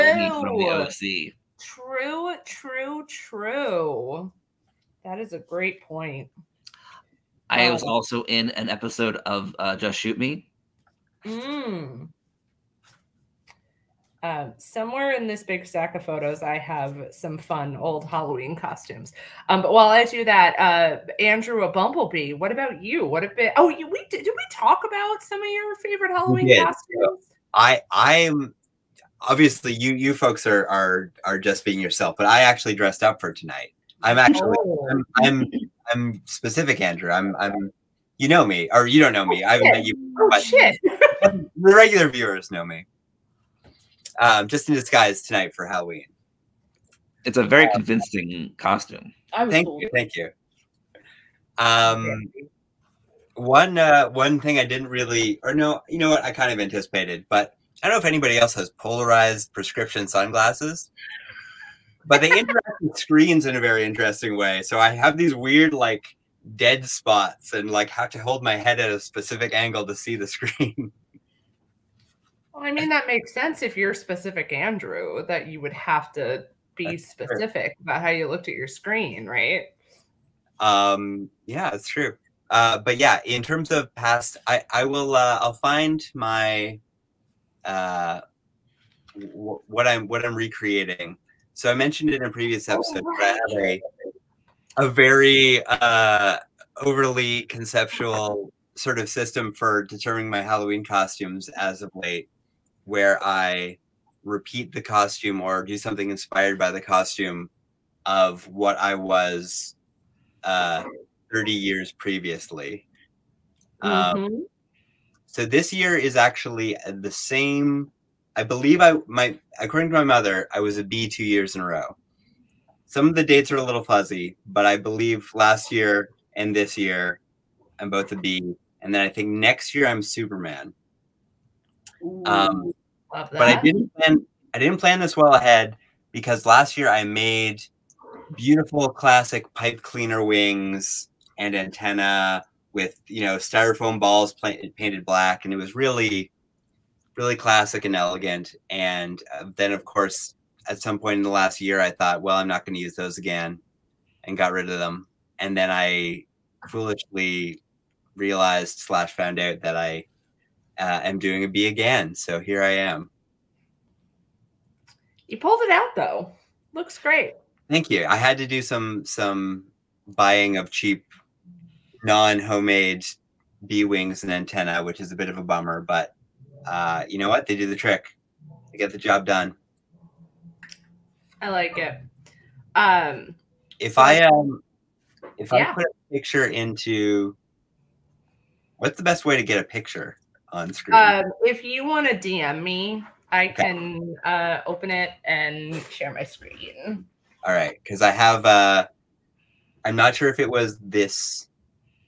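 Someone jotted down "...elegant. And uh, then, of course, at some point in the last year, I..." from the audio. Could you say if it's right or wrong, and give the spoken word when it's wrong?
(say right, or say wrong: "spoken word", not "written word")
right.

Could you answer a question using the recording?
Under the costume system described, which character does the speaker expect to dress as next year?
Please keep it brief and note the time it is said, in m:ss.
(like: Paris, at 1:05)
Superman, at 2:10.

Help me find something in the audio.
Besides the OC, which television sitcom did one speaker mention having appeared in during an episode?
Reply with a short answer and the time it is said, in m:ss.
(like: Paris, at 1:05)
Just Shoot Me, at 0:09.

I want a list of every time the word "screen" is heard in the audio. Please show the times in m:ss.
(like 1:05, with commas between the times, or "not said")
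1:02, 1:10, 1:18, 3:10, 3:16.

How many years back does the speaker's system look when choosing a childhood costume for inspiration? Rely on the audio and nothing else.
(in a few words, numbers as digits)
30.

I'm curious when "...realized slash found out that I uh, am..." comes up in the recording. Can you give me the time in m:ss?
2:38.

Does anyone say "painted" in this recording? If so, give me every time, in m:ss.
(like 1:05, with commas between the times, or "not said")
2:24.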